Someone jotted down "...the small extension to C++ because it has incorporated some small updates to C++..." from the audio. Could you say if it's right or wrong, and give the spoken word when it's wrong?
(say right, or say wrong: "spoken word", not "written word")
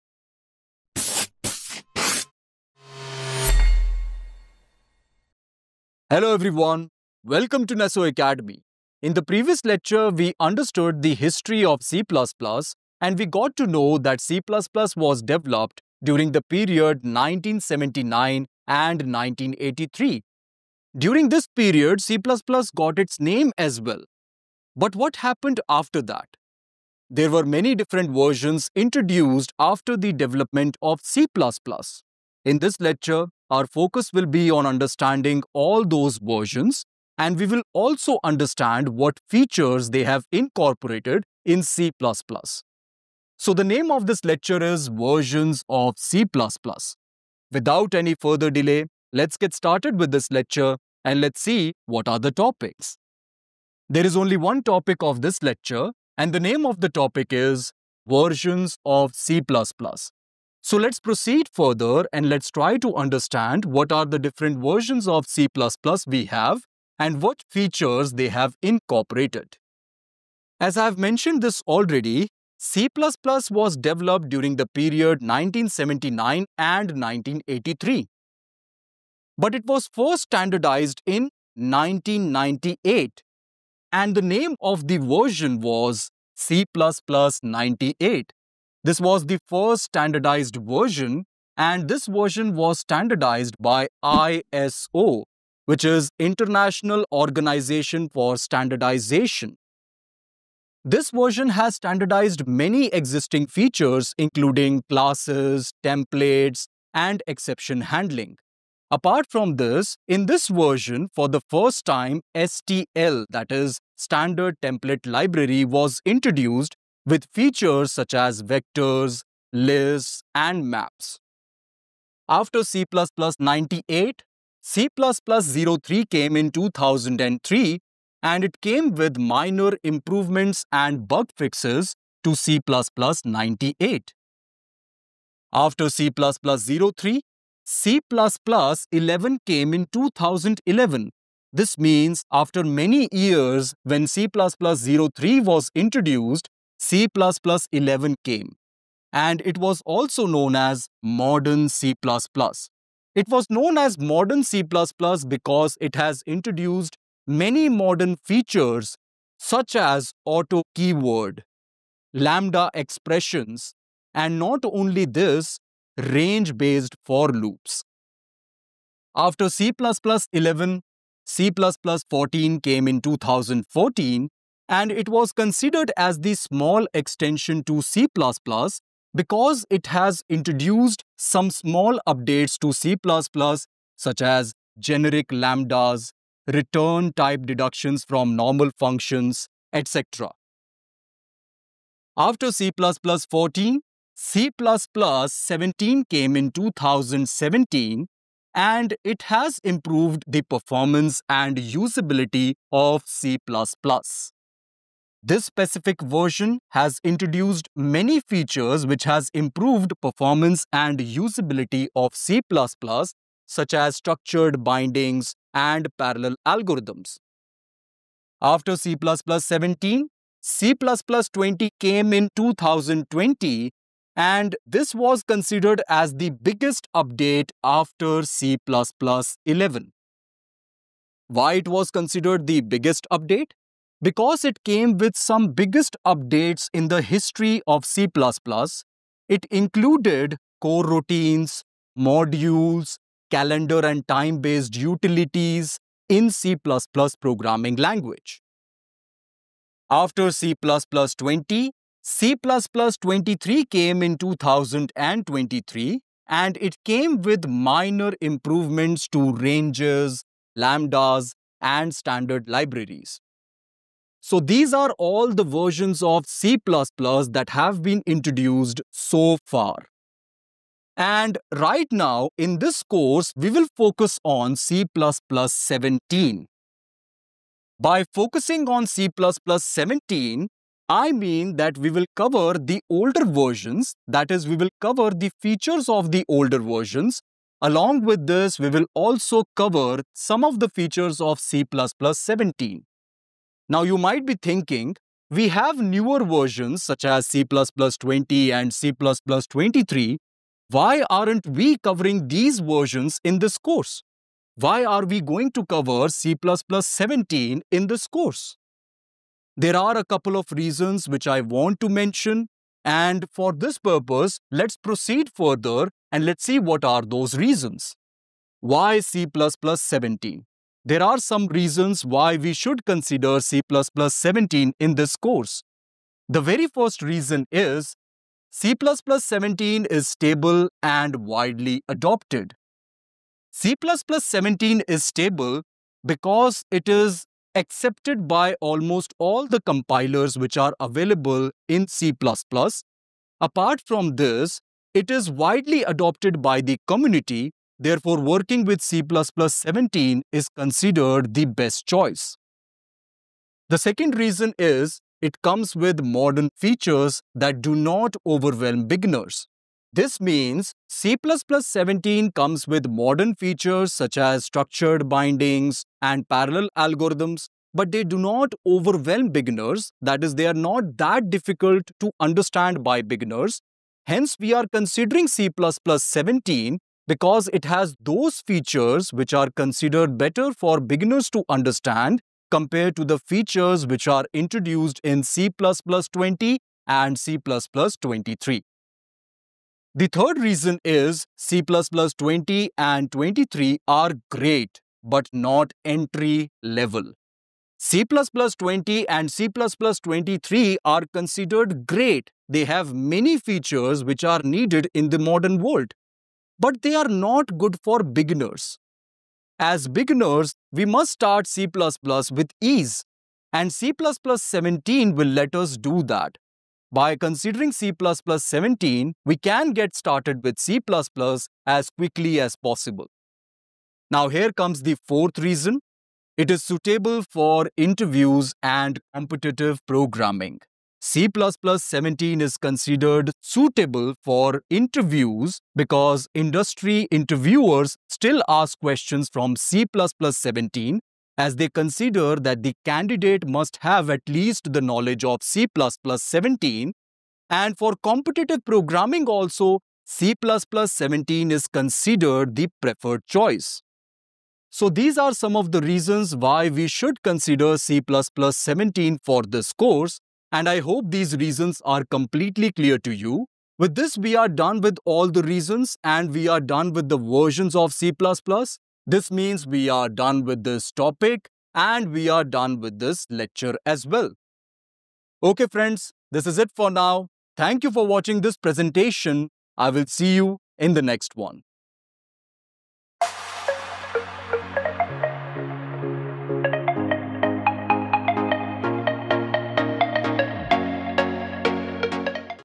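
wrong: "introduced", not "incorporated".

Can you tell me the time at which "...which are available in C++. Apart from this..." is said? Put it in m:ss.
5:40.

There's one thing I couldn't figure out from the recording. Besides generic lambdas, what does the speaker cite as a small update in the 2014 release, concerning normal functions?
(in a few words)
return type deductions.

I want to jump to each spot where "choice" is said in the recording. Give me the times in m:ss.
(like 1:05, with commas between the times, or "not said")
5:51, 7:33.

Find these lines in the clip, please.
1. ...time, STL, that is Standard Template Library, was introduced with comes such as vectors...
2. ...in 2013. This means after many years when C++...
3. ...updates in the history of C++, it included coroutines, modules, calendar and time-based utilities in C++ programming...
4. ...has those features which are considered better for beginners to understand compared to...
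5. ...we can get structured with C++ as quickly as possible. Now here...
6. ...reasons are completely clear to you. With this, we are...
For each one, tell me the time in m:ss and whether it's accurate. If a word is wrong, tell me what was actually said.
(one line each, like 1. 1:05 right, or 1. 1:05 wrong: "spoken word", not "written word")
1. 1:51 wrong: "features", not "comes"
2. 2:19 wrong: "2011", not "2013"
3. 3:56 right
4. 6:17 right
5. 6:59 wrong: "started", not "structured"
6. 7:41 right.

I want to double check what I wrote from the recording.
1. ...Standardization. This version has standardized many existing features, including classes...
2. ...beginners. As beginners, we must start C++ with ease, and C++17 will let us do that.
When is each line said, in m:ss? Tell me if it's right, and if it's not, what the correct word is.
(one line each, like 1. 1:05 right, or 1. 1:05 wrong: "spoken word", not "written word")
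1. 1:38 right
2. 6:48 right.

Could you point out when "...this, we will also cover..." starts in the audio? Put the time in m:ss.
4:48.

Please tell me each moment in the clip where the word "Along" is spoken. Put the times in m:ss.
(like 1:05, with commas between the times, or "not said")
4:47.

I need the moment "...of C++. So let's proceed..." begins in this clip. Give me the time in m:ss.
0:58.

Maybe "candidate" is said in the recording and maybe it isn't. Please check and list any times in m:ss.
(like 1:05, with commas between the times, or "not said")
7:22.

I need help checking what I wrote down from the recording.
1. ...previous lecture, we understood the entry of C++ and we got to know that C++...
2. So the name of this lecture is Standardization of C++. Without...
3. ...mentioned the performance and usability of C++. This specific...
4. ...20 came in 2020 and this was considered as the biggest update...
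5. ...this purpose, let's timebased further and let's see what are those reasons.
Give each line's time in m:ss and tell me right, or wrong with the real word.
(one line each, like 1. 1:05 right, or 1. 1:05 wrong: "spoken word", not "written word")
1. 0:09 wrong: "history", not "entry"
2. 0:43 wrong: "Versions", not "Standardization"
3. 3:19 wrong: "improved", not "mentioned"
4. 3:41 right
5. 5:13 wrong: "proceed", not "timebased".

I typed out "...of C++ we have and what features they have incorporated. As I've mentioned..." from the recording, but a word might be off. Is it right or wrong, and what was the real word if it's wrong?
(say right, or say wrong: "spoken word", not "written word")
right.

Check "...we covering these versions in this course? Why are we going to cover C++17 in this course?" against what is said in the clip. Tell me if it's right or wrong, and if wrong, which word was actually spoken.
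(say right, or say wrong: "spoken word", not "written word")
right.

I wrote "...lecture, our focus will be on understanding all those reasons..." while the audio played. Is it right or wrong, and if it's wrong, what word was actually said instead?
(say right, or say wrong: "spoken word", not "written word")
wrong: "versions", not "reasons".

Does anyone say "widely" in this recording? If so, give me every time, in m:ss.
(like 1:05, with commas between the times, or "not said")
5:31, 5:45.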